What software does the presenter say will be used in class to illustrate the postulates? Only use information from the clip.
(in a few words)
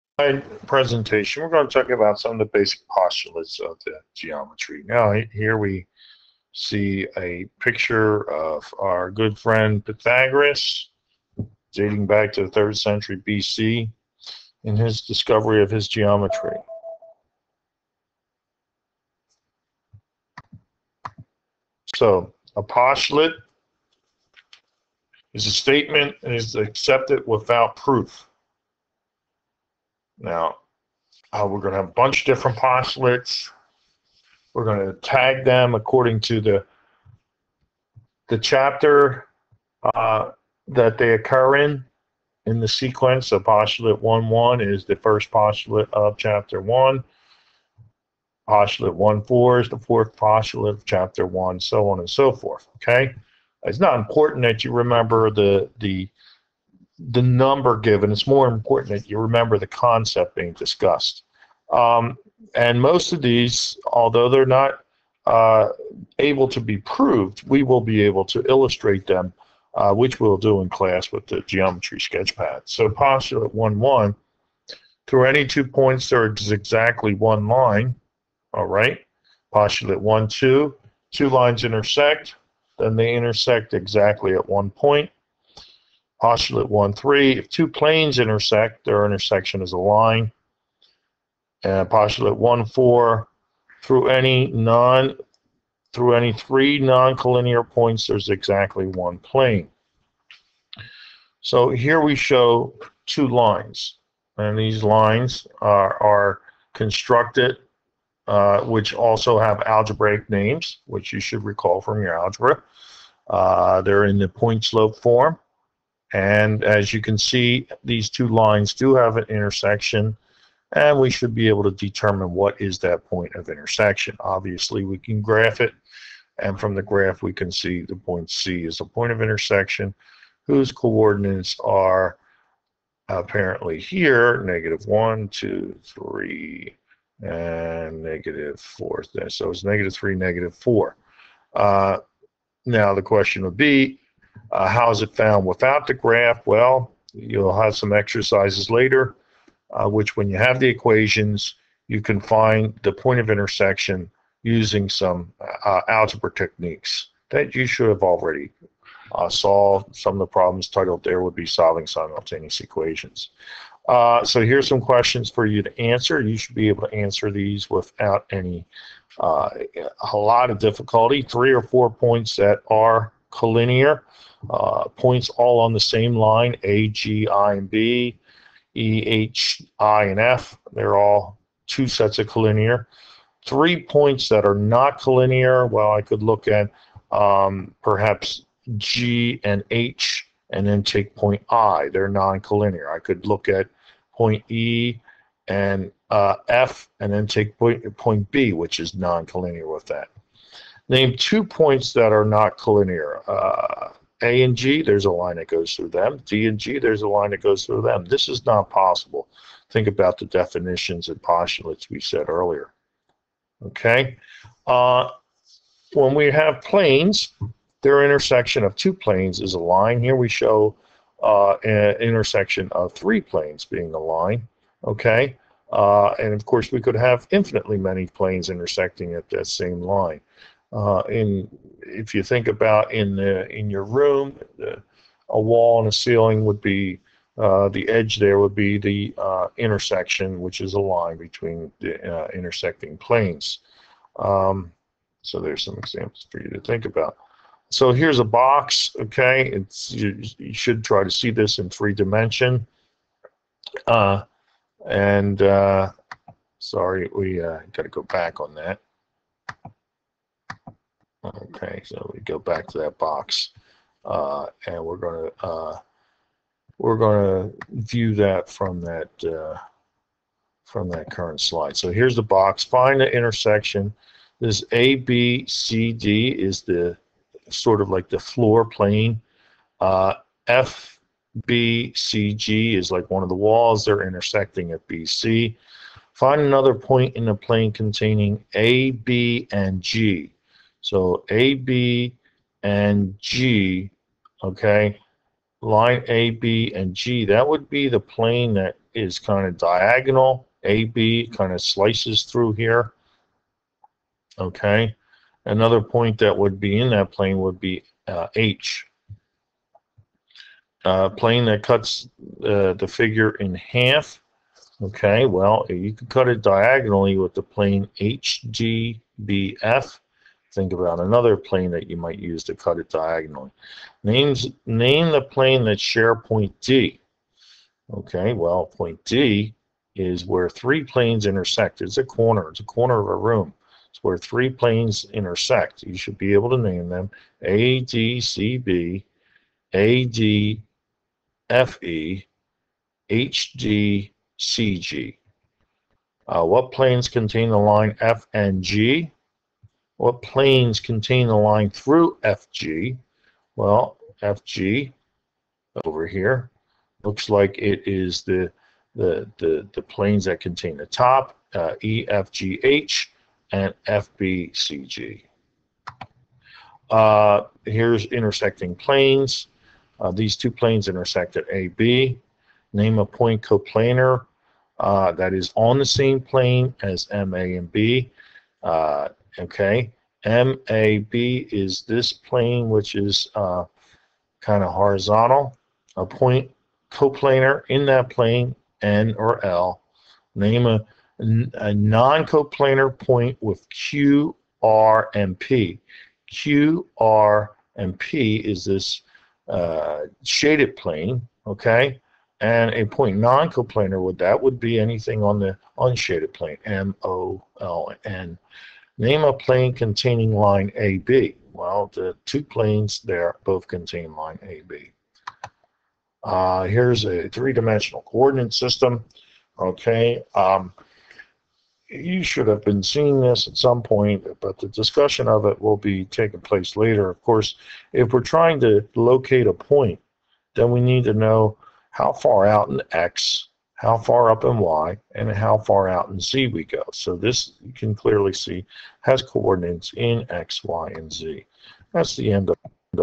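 Geometer's Sketchpad.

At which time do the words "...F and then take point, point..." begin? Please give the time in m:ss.
3:16.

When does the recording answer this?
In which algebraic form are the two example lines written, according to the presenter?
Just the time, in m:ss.
1:54.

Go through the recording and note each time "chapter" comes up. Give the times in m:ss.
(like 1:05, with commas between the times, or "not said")
0:38, 0:46, 0:50.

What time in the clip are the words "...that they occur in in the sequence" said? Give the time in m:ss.
0:40.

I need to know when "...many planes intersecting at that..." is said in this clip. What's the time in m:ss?
3:47.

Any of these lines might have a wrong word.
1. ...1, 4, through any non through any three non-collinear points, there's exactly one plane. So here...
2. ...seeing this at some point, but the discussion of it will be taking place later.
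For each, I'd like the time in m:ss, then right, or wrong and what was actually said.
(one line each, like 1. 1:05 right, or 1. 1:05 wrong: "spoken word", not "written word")
1. 1:32 right
2. 7:02 right.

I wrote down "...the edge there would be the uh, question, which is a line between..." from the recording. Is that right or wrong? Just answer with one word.
wrong.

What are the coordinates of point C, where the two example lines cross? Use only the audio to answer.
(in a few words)
(-3, -4).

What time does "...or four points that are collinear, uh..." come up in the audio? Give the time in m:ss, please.
2:51.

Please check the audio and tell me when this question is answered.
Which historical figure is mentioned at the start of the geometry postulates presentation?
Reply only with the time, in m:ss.
0:09.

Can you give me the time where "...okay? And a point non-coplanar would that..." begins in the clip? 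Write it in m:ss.
6:41.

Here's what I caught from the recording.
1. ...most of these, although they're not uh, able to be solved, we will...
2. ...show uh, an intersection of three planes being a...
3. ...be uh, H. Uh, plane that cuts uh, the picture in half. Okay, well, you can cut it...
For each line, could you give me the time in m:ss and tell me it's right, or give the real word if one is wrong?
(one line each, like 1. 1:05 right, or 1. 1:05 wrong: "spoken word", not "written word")
1. 1:02 wrong: "proved", not "solved"
2. 3:40 right
3. 5:07 wrong: "figure", not "picture".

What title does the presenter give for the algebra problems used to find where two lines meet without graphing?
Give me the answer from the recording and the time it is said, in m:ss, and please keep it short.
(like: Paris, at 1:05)
solving simultaneous equations, at 2:41.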